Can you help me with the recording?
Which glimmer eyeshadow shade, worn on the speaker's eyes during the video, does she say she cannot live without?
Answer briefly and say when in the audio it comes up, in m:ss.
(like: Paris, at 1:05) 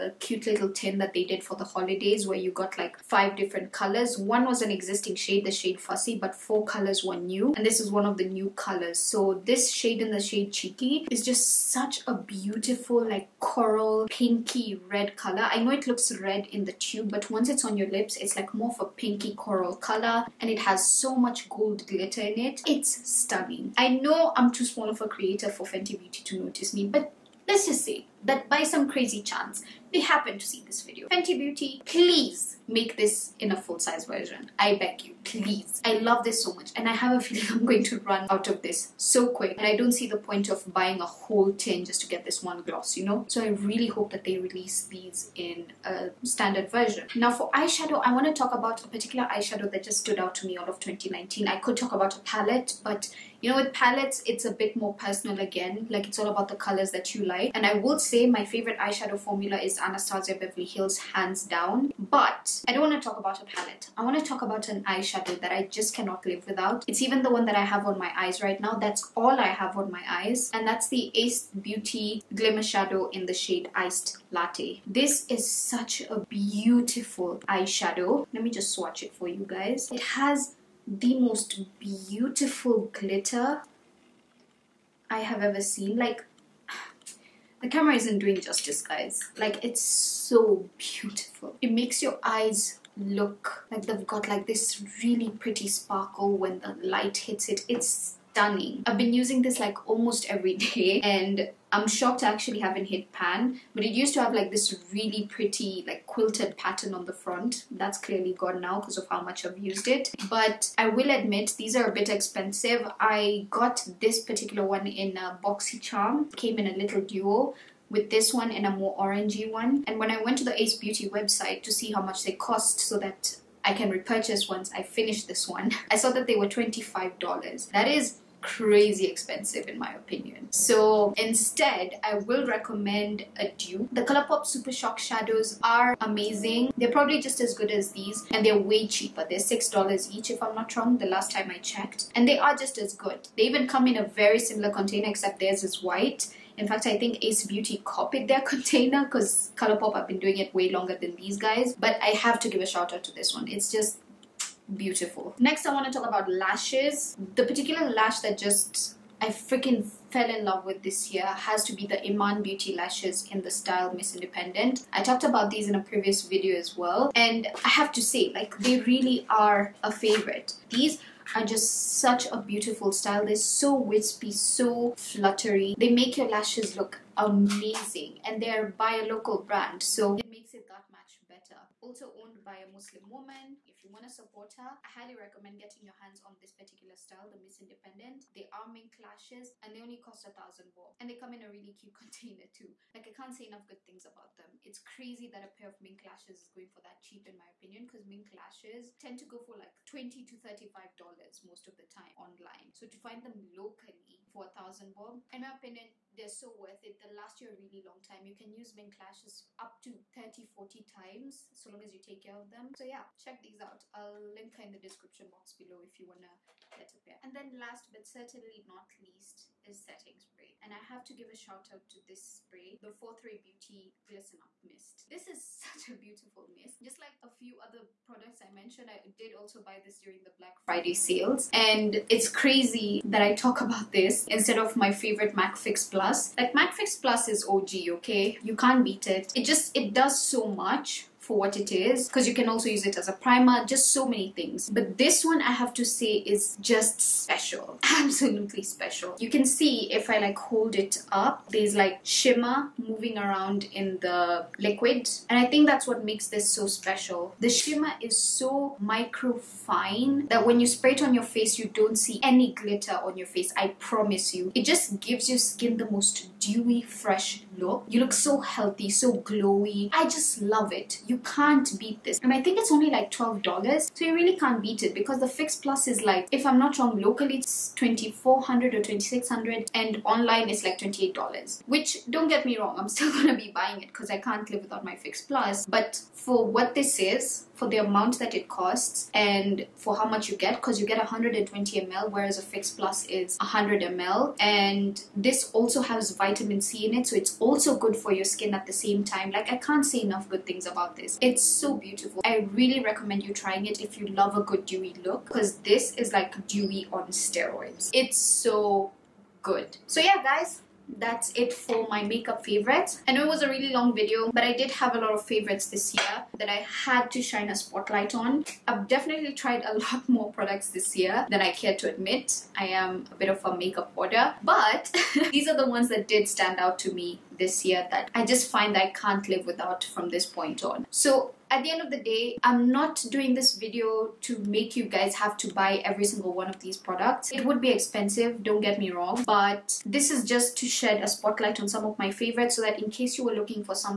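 Iced Latte, at 1:13.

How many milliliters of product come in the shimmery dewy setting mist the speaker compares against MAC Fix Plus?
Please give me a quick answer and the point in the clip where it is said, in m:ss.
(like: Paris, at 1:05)
120 ml, at 4:50.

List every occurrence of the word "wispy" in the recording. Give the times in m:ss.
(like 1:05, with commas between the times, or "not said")
2:53.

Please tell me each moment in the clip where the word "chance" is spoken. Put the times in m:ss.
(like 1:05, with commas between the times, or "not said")
0:29.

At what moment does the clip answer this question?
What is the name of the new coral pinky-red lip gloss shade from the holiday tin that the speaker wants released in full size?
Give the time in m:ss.
0:10.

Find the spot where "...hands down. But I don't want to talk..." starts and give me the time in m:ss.
1:00.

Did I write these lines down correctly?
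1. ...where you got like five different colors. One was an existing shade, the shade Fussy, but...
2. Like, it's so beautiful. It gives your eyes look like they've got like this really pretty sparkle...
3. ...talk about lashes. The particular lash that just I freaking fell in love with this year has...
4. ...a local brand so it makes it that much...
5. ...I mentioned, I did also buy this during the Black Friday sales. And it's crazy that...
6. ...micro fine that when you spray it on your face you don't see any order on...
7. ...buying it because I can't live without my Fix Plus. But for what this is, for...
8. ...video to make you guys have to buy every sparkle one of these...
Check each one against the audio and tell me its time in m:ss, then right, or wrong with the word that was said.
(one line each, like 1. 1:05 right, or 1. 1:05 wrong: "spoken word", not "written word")
1. 0:02 right
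2. 1:29 wrong: "makes", not "gives"
3. 2:35 right
4. 2:58 right
5. 3:48 right
6. 4:18 wrong: "glitter", not "order"
7. 4:43 right
8. 5:33 wrong: "single", not "sparkle".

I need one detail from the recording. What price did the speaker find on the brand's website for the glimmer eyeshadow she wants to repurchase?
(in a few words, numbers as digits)
$25.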